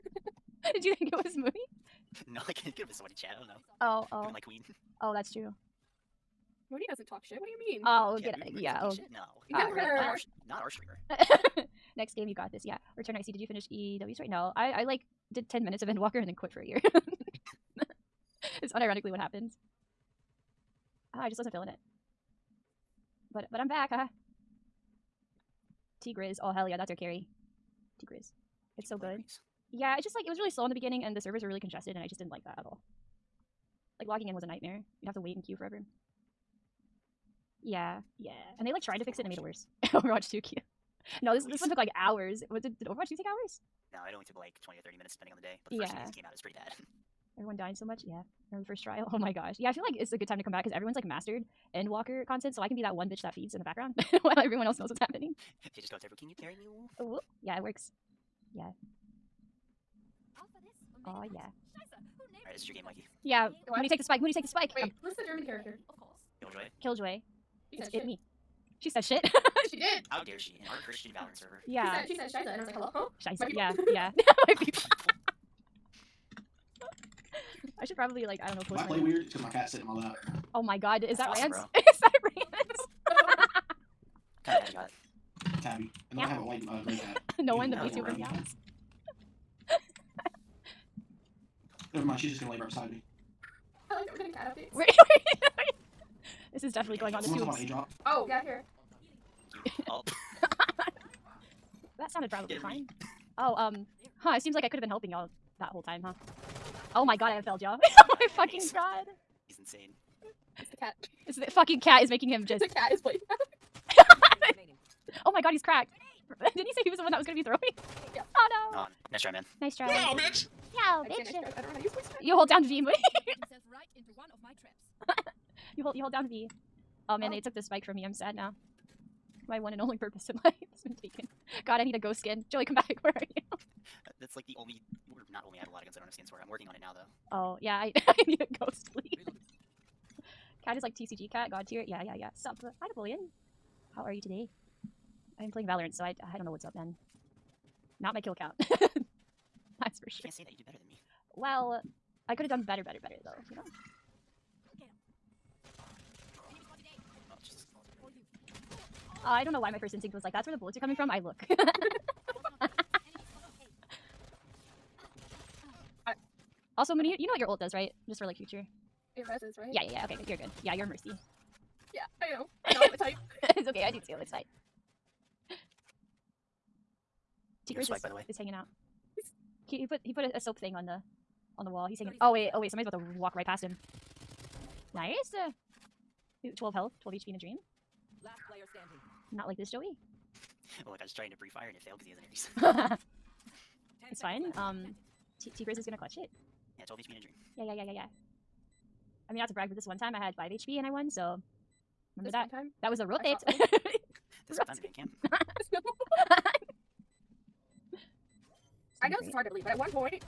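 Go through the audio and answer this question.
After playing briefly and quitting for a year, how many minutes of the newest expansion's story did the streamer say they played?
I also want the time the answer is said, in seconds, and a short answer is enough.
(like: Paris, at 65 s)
10, at 15 s.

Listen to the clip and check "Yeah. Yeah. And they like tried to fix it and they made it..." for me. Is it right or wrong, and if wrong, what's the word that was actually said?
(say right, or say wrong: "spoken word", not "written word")
right.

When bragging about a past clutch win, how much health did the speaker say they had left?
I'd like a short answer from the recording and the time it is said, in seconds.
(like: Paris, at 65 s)
5 HP, at 200 s.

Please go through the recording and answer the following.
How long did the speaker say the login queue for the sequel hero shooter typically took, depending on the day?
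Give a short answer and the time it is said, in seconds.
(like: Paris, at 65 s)
20 to 30 minutes, at 44 s.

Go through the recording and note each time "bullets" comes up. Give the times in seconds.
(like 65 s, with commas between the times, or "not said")
160 s.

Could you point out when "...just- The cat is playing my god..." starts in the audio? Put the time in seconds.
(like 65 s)
112 s.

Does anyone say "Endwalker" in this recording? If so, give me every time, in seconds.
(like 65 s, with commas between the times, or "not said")
15 s, 51 s.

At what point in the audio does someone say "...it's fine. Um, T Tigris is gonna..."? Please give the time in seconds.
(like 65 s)
194 s.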